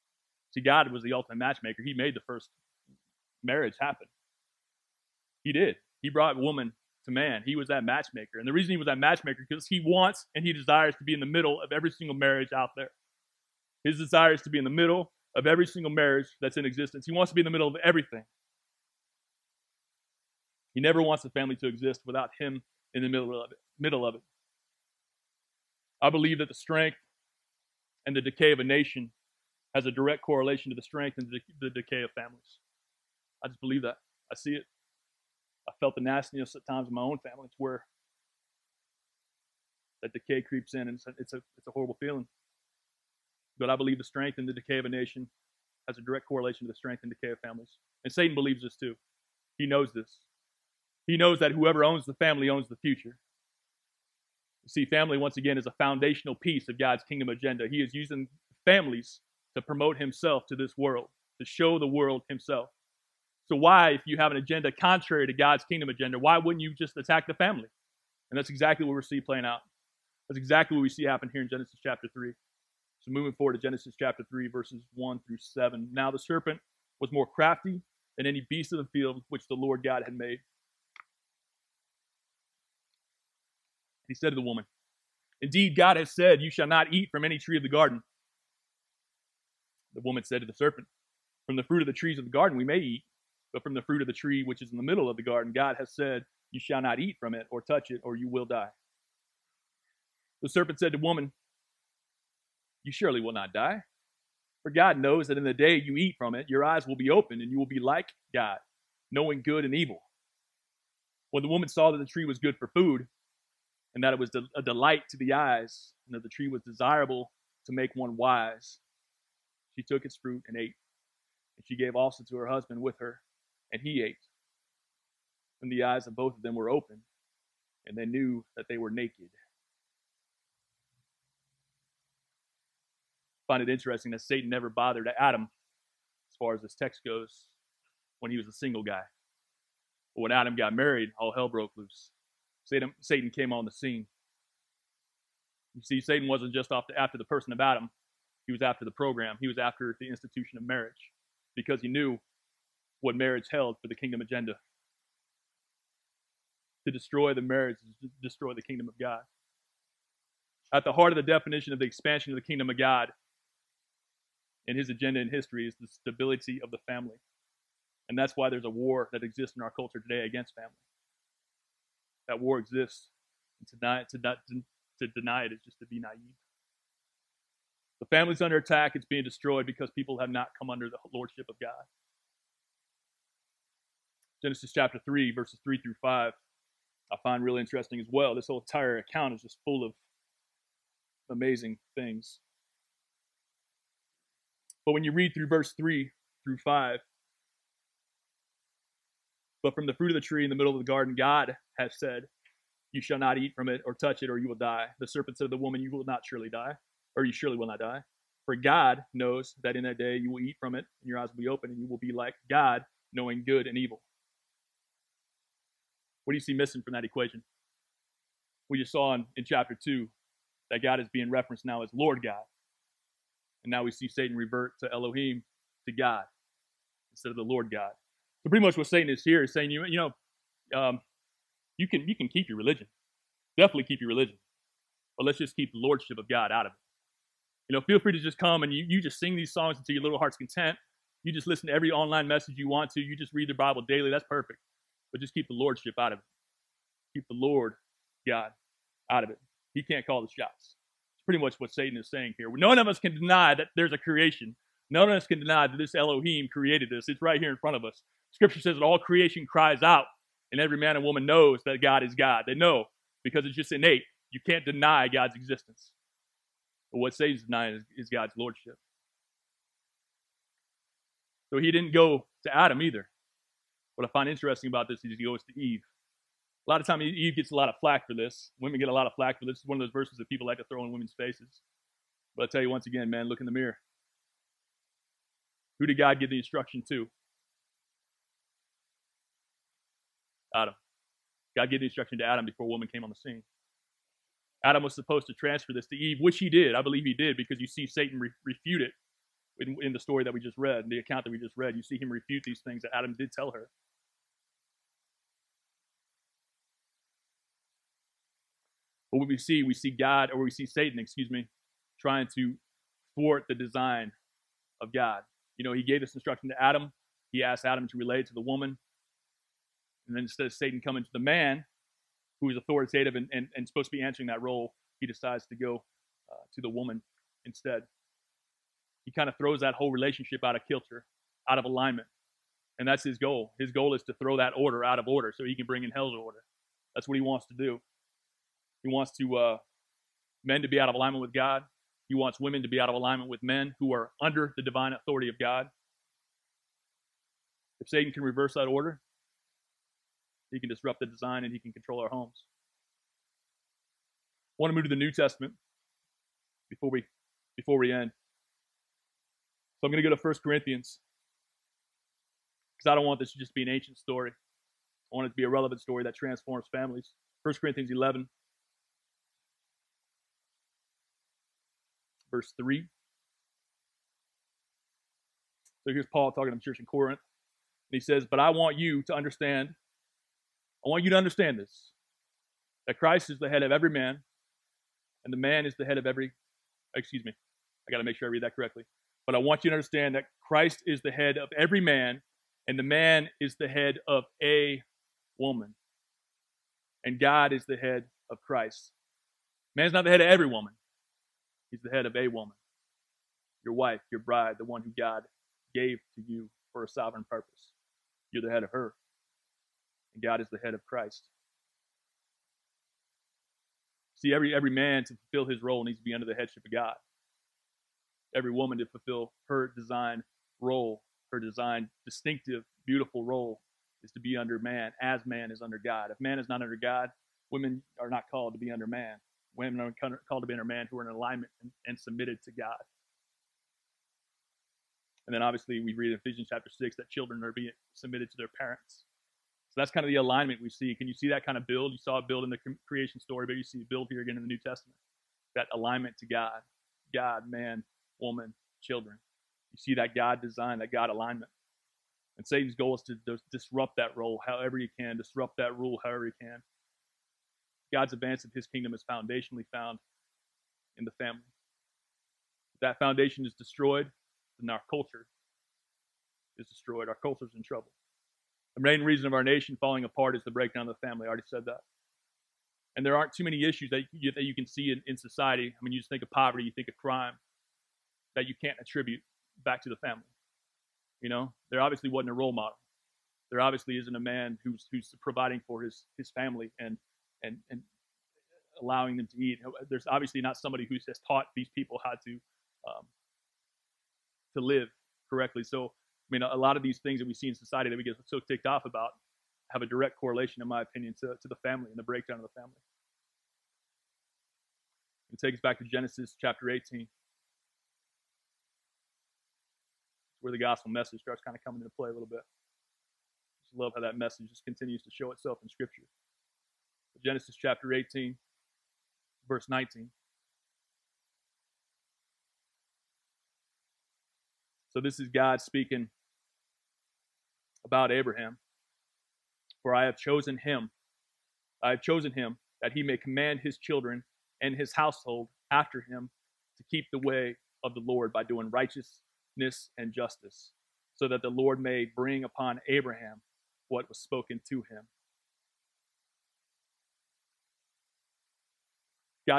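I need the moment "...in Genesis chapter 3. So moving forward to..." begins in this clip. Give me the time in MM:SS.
01:11.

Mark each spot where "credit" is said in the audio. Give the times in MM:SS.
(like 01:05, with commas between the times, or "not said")
not said.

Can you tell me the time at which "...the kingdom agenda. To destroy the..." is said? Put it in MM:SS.
02:33.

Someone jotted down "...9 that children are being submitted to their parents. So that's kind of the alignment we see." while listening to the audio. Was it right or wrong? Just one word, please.
wrong.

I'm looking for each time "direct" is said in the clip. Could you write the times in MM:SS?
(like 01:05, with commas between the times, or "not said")
00:29, 00:46, 08:19.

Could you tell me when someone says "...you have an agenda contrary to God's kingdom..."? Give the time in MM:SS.
01:04.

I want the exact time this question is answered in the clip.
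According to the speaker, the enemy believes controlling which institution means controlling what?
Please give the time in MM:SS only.
00:52.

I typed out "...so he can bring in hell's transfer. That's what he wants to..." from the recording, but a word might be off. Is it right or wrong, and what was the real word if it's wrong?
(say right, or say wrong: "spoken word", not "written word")
wrong: "order", not "transfer".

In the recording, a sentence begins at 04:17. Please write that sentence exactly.
It's right here in front of us.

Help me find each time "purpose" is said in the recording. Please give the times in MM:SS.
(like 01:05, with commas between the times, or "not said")
06:47.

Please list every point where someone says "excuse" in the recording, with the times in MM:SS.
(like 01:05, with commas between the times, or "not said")
05:10, 06:26.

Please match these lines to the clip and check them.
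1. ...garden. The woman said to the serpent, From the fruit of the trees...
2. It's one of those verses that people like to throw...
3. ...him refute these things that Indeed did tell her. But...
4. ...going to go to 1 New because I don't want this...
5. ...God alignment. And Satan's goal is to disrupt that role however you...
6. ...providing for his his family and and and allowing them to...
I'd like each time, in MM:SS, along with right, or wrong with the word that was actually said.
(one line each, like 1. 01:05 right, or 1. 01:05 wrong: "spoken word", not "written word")
1. 01:27 right
2. 04:39 right
3. 05:02 wrong: "Adam", not "Indeed"
4. 05:59 wrong: "Corinthians", not "New"
5. 07:30 right
6. 08:05 right.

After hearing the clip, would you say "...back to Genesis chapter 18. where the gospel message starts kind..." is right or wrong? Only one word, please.
right.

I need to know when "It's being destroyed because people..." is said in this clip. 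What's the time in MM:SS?
02:58.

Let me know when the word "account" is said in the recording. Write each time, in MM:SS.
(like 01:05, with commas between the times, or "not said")
03:08, 05:00.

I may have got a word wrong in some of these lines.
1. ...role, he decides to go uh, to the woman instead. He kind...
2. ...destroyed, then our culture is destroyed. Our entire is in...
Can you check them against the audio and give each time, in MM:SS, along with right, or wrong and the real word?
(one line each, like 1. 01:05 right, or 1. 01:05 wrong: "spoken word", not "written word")
1. 05:24 right
2. 07:43 wrong: "culture", not "entire".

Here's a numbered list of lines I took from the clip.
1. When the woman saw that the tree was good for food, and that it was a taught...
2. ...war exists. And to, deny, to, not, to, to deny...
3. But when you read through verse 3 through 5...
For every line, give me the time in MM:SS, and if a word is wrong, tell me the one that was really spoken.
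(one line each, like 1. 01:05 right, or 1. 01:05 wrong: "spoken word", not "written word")
1. 01:51 wrong: "delight", not "taught"
2. 02:52 right
3. 03:14 right.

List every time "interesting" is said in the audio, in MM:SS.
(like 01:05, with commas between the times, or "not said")
02:13, 03:07, 04:34.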